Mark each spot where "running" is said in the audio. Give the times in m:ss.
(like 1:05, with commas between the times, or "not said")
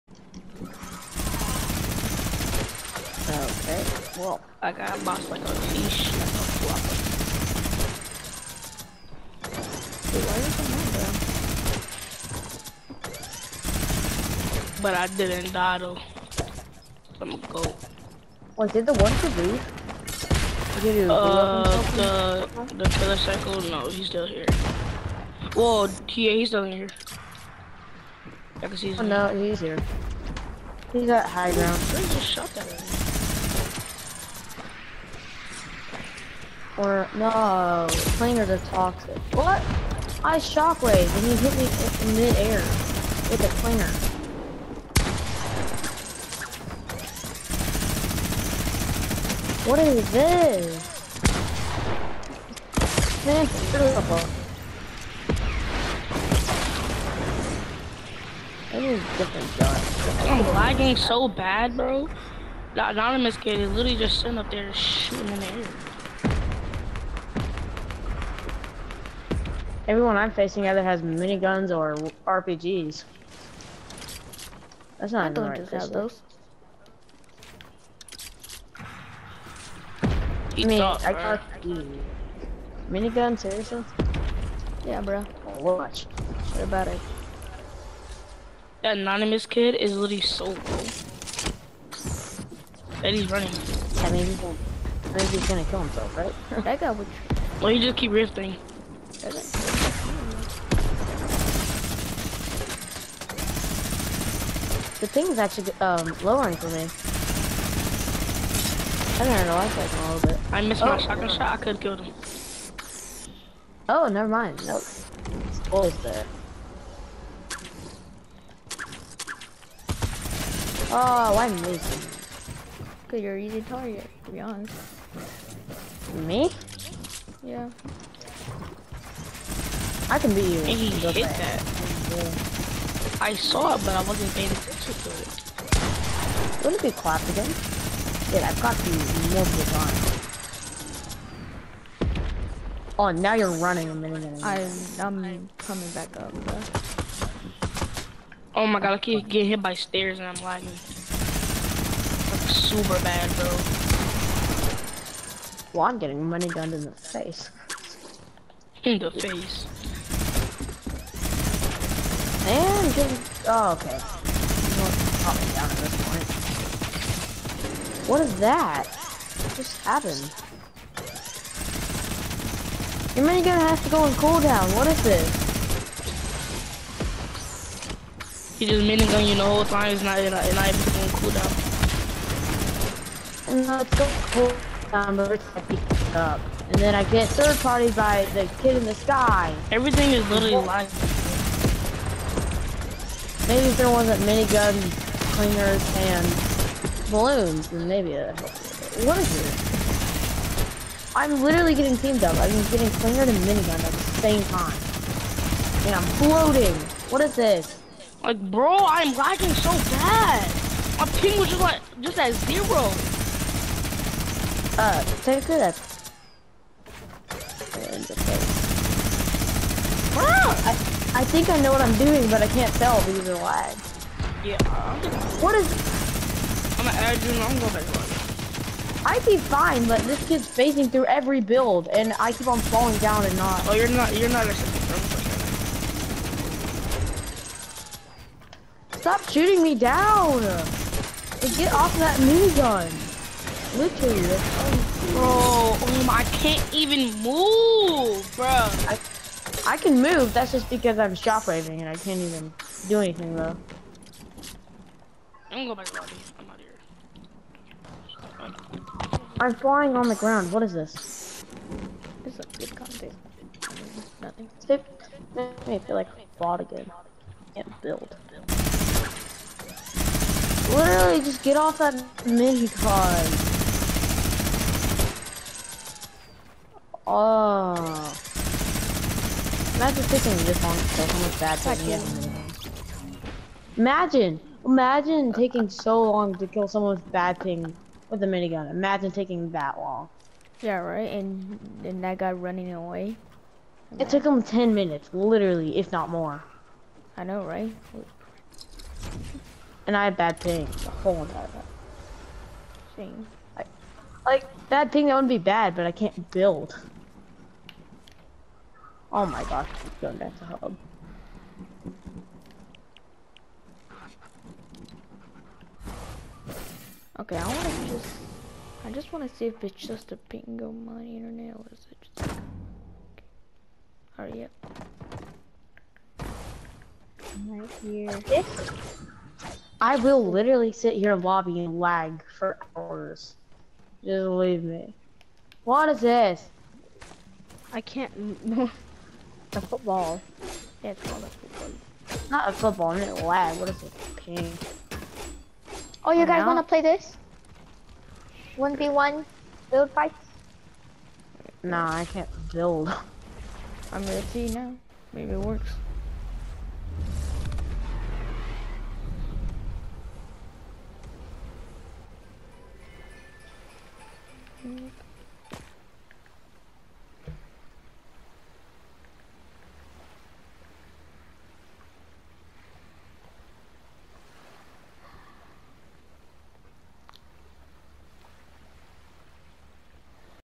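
1:33, 2:23, 4:52.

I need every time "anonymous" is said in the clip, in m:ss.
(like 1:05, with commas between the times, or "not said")
1:02, 1:28.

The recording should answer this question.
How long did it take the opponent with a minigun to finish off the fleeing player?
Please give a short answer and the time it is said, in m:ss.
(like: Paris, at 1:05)
10 minutes, at 4:54.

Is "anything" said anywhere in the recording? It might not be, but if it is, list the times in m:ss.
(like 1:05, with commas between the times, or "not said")
4:12.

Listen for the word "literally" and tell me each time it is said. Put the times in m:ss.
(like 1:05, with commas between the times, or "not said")
1:03, 1:29, 3:10, 3:21, 4:03, 4:30, 4:55, 5:30.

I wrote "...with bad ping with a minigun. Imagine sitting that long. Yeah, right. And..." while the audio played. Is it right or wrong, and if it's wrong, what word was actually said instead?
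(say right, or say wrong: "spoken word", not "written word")
wrong: "taking", not "sitting".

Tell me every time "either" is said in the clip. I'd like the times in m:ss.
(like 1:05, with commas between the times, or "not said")
1:10.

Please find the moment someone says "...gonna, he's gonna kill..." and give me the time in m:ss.
1:34.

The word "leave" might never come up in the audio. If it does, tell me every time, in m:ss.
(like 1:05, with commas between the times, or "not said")
0:19, 5:34.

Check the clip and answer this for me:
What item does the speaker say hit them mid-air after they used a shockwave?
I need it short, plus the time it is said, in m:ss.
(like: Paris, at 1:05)
planer, at 0:43.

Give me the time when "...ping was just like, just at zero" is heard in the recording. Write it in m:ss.
3:31.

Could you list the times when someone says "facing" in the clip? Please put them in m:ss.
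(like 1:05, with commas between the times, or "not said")
1:10, 3:50.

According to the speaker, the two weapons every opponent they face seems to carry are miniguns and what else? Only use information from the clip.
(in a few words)
RPGs.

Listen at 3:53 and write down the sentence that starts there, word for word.
Oh, you're not, you're not Stop shooting me down!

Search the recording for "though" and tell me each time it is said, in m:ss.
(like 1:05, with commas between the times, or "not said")
0:15, 4:13.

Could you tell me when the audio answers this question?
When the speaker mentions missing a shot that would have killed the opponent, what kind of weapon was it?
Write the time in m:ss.
1:50.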